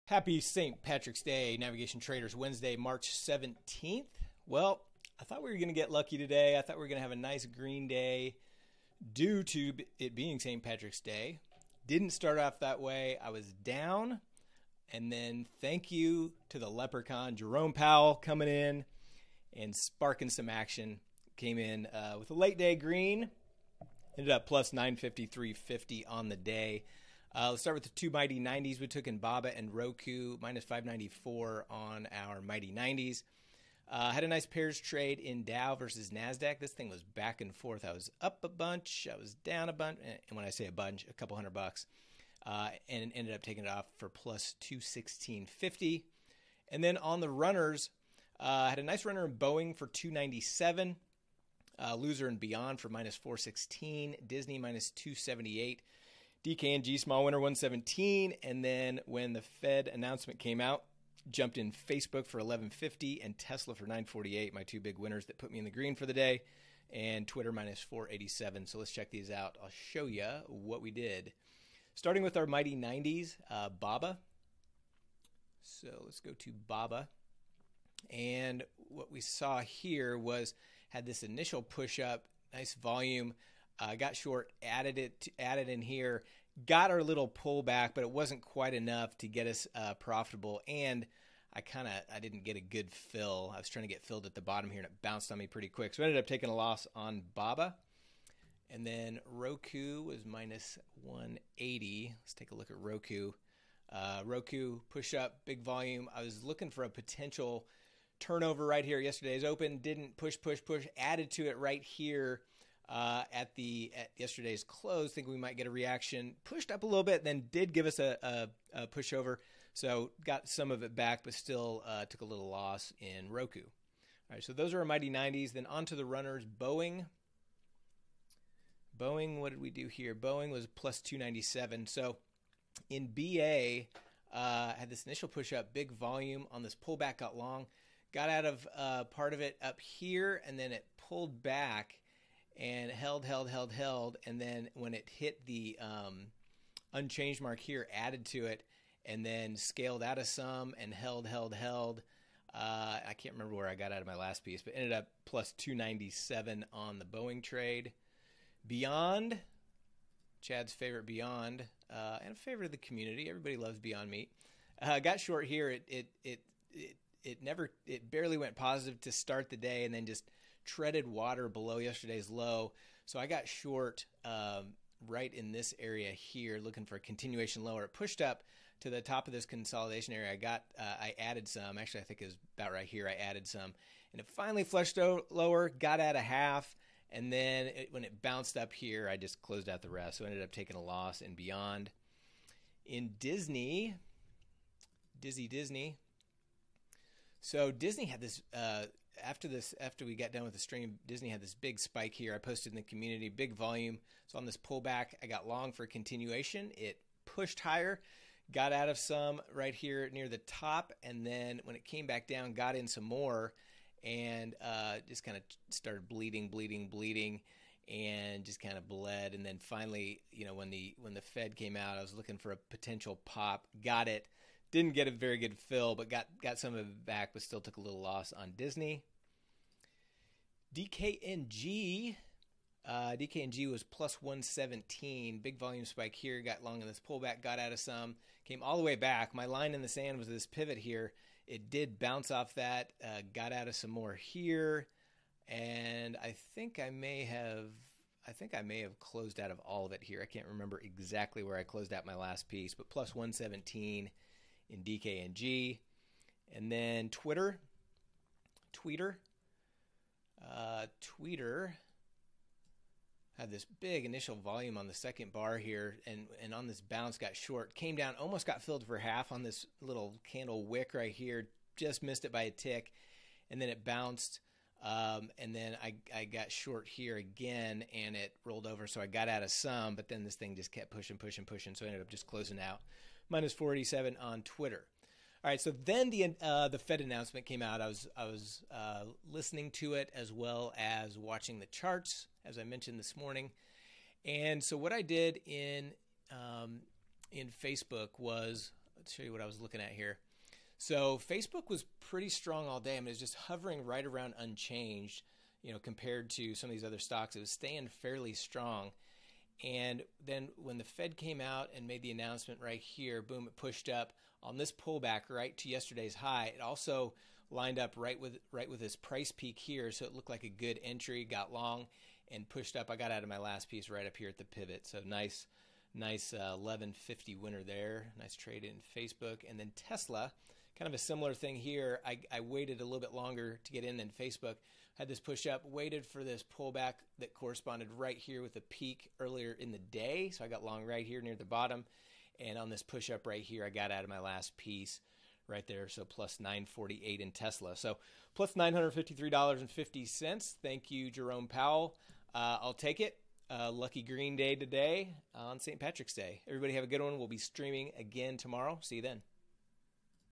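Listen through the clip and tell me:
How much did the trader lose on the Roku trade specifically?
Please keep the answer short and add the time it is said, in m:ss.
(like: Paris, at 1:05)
$180, at 1:40.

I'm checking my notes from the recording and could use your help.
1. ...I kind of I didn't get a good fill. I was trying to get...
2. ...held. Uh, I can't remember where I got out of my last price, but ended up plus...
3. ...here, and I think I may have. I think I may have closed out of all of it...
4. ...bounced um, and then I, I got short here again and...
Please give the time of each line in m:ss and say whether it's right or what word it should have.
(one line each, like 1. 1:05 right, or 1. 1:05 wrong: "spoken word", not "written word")
1. 1:31 right
2. 2:31 wrong: "piece", not "price"
3. 4:04 right
4. 4:33 right.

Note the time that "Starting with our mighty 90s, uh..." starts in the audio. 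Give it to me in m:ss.
1:11.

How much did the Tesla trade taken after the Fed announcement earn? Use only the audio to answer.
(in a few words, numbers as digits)
$948.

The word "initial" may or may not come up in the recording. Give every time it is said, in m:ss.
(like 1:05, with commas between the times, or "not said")
1:21, 2:15, 4:24.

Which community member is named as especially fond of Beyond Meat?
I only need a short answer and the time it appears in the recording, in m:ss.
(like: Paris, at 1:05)
Chad, at 2:40.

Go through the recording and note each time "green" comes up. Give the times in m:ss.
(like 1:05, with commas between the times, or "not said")
0:07, 0:22, 1:05, 5:54.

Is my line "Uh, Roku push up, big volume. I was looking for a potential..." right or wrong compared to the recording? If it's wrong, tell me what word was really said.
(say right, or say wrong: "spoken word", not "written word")
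right.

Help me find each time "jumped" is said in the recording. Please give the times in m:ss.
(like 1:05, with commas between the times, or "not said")
1:01.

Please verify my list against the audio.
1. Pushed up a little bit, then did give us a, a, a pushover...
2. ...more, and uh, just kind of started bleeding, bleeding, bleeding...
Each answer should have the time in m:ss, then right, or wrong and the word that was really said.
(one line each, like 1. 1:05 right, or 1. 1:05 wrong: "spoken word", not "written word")
1. 1:56 right
2. 3:33 right.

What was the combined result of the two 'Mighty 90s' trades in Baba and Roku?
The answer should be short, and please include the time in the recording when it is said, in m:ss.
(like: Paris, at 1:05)
-$594, at 0:30.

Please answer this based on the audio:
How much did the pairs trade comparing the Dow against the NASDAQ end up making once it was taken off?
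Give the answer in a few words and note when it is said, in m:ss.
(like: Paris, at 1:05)
$216.50, at 0:44.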